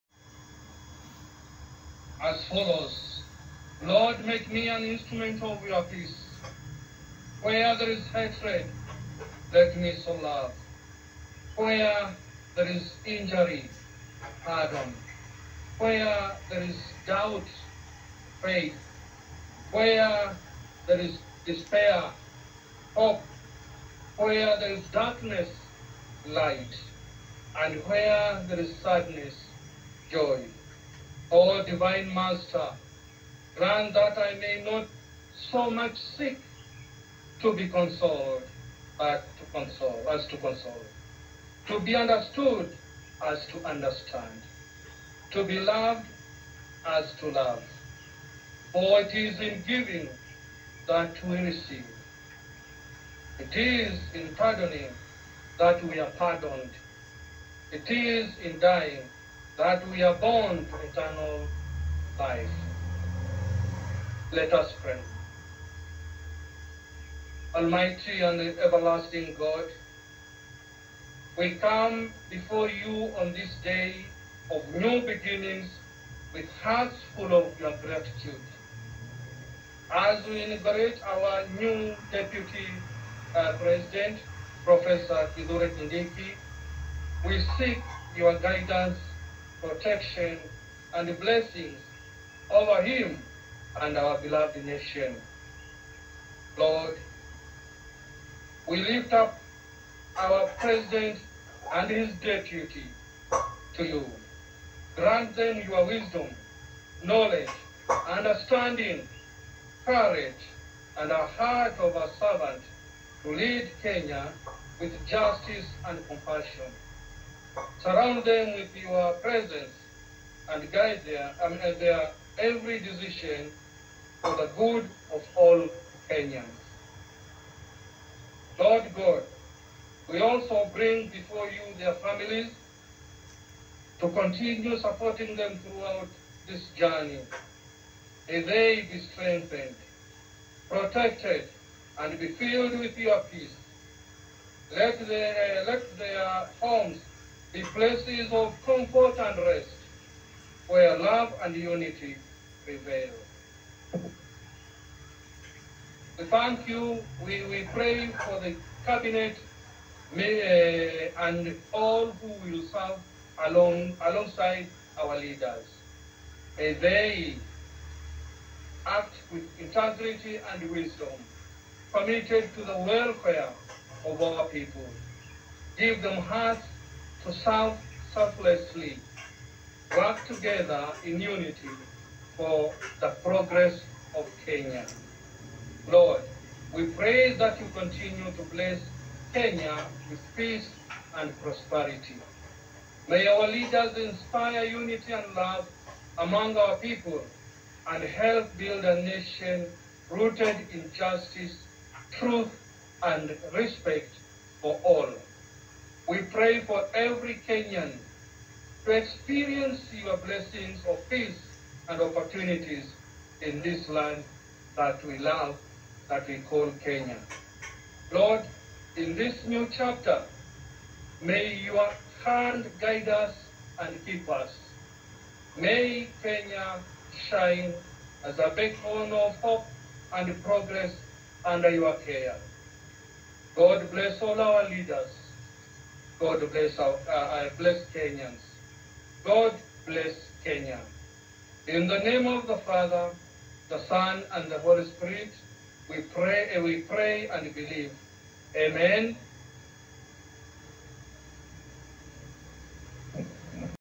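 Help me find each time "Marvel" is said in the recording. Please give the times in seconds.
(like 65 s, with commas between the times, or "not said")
not said.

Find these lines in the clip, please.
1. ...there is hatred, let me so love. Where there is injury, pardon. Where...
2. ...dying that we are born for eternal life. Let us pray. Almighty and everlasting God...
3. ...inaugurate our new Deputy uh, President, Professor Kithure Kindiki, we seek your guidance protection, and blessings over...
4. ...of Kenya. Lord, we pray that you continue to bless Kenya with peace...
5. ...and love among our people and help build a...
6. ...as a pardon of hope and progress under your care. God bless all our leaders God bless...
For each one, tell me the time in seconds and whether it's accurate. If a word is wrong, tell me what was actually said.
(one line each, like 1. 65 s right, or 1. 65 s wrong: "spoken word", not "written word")
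1. 7 s right
2. 58 s right
3. 80 s right
4. 184 s right
5. 195 s right
6. 228 s wrong: "beacon", not "pardon".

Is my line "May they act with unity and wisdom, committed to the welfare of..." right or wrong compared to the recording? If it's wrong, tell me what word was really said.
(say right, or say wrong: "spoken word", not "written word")
wrong: "integrity", not "unity".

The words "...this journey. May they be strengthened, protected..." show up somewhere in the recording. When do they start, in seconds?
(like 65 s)
136 s.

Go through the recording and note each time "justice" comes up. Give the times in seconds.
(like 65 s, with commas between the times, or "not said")
115 s, 200 s.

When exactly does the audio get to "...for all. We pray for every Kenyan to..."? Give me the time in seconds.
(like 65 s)
204 s.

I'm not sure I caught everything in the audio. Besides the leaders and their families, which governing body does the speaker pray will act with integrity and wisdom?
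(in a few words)
The cabinet.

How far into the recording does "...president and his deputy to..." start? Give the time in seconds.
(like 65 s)
100 s.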